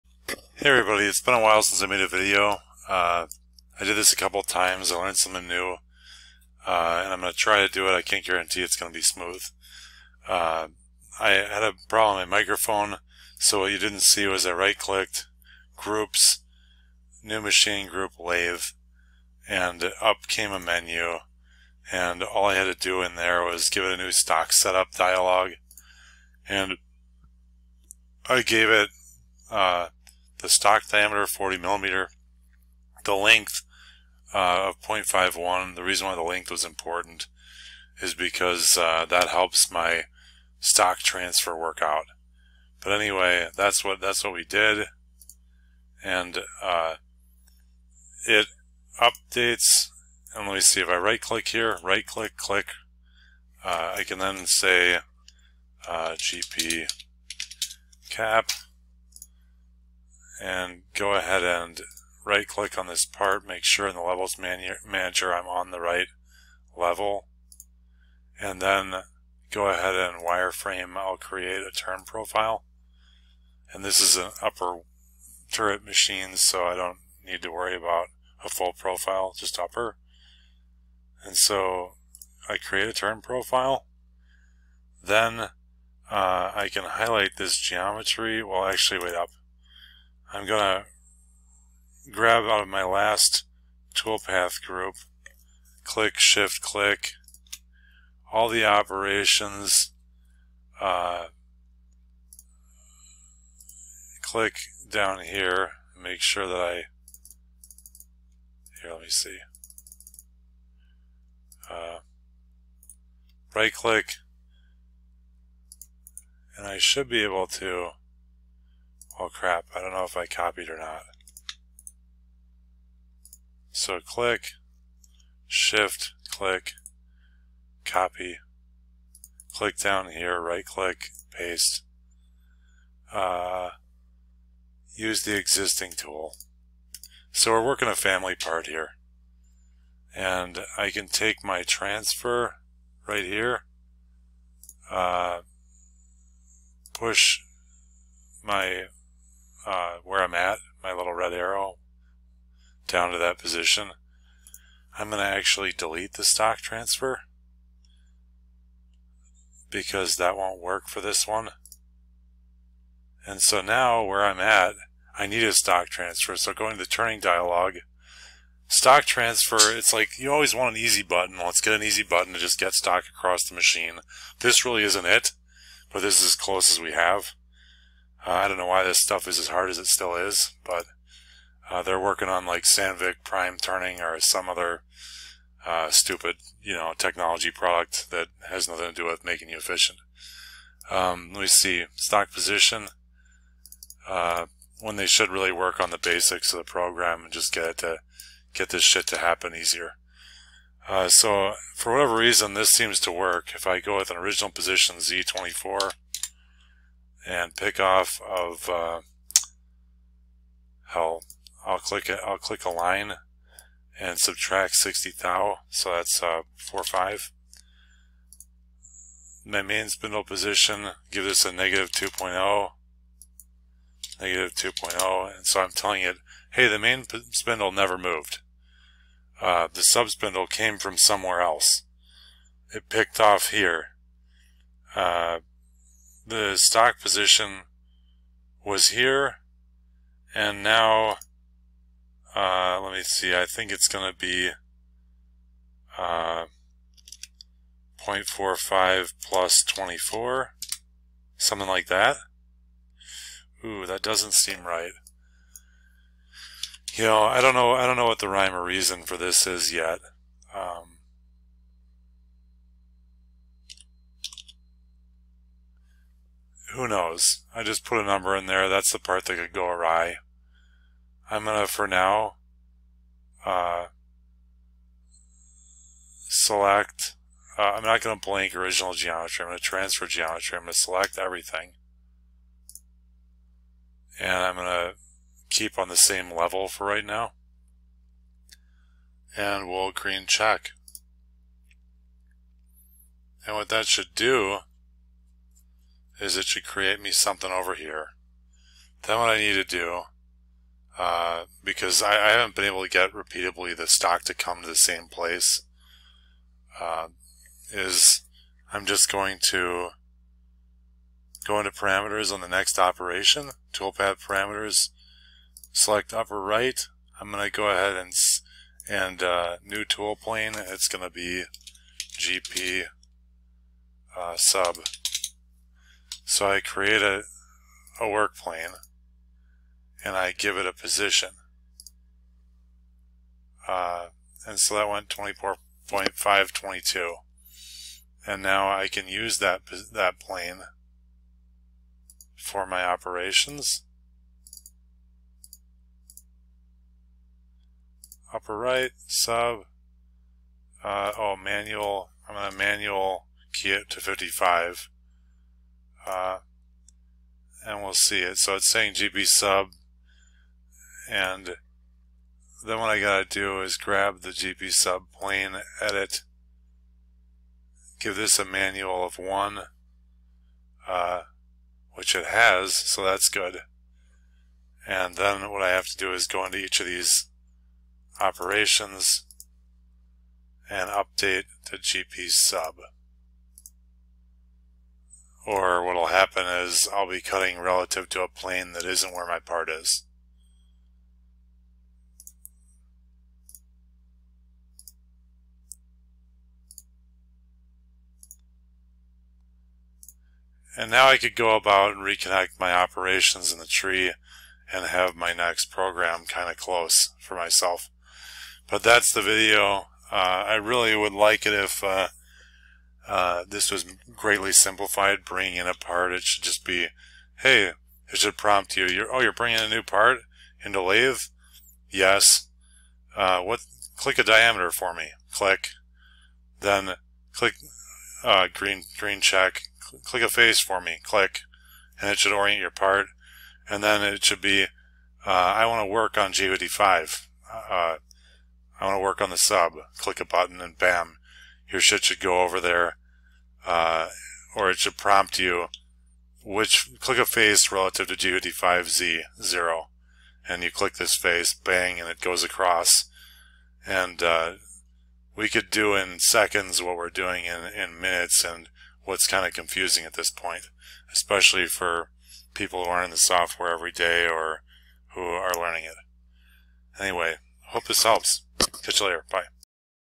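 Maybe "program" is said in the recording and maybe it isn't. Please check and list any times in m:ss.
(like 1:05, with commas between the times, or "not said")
3:16, 6:45.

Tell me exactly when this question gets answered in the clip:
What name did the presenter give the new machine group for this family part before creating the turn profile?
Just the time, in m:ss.
0:56.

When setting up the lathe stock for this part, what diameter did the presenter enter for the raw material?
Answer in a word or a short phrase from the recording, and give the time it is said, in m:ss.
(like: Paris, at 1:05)
40 millimeter, at 0:30.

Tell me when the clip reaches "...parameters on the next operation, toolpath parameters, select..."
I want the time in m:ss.
5:11.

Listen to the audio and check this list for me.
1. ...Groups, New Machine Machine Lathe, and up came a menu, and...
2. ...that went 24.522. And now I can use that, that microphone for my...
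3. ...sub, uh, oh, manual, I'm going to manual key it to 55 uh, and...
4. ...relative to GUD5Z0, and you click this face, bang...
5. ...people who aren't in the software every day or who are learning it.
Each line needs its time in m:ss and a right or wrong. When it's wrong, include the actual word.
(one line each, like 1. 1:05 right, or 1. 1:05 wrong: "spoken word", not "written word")
1. 0:15 wrong: "Group", not "Machine"
2. 5:34 wrong: "plane", not "microphone"
3. 5:49 right
4. 7:27 right
5. 7:42 right.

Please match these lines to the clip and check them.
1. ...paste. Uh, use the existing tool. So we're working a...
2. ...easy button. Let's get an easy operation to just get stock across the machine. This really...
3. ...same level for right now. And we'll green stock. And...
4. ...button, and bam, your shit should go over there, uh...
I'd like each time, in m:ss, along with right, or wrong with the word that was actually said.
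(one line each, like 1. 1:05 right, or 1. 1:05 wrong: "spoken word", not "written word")
1. 2:11 right
2. 2:50 wrong: "button", not "operation"
3. 4:45 wrong: "check", not "stock"
4. 7:20 right.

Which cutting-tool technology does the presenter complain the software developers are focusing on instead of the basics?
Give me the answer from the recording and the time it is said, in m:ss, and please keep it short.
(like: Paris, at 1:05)
Sandvik Prime Turning, at 3:02.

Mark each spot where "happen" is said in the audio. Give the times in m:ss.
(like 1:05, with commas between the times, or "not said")
3:19, 6:26.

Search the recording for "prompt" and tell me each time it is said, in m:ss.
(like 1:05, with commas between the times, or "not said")
6:58, 7:24.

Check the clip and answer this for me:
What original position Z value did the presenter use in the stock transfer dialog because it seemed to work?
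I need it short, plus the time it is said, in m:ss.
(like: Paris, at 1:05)
Z24, at 3:24.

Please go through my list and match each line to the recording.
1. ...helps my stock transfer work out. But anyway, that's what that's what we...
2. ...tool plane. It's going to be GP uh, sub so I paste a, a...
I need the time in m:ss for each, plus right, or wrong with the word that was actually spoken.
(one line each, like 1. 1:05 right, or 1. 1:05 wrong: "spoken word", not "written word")
1. 0:39 right
2. 5:19 wrong: "create", not "paste".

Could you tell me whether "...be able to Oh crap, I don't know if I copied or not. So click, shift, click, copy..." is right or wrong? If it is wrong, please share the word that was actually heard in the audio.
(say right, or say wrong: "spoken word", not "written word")
right.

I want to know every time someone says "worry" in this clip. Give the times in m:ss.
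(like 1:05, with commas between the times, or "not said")
1:17.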